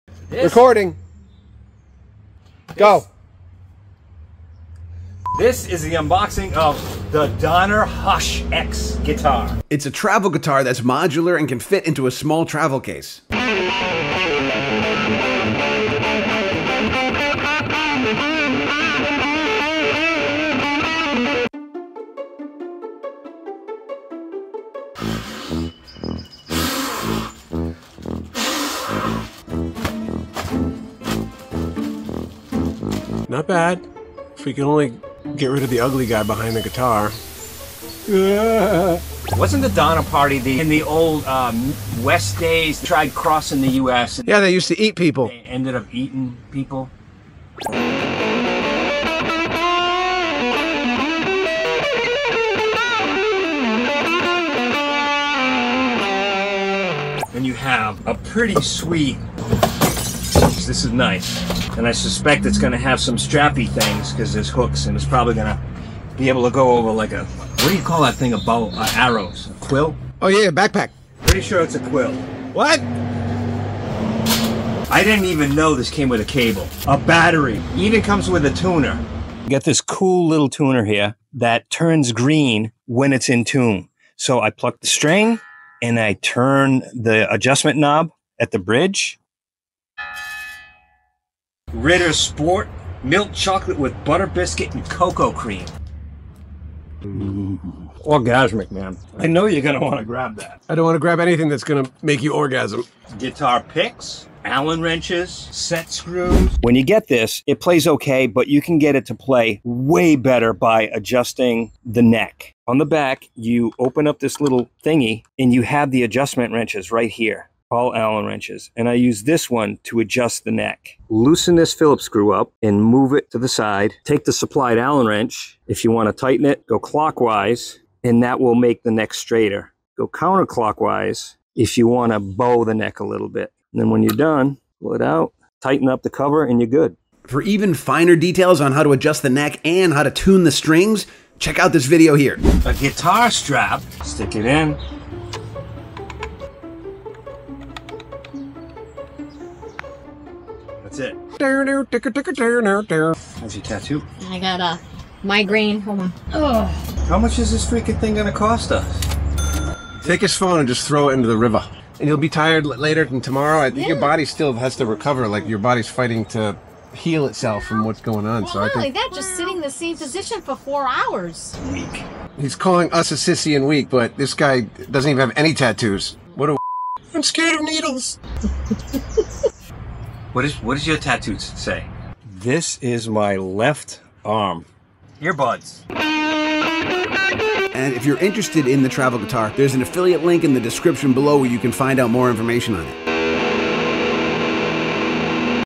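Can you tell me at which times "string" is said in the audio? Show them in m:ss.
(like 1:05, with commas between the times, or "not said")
1:24, 2:20.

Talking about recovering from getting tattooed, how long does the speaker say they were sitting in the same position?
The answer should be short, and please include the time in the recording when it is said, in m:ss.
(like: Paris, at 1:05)
4 hours, at 2:50.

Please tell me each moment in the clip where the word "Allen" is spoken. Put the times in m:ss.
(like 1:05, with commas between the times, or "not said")
1:44, 1:57, 2:04.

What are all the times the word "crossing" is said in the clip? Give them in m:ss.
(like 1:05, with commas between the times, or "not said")
0:43.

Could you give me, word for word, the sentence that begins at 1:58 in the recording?
And I use this one to adjust the neck.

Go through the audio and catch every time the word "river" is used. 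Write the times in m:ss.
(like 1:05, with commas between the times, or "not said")
2:41.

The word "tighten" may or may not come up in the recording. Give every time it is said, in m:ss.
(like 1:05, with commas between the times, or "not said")
2:06, 2:15.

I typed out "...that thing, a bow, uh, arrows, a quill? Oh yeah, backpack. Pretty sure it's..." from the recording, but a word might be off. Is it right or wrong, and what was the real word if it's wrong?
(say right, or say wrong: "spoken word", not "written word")
right.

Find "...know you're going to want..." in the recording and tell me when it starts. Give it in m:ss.
1:39.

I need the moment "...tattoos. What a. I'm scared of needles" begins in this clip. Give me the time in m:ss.
2:55.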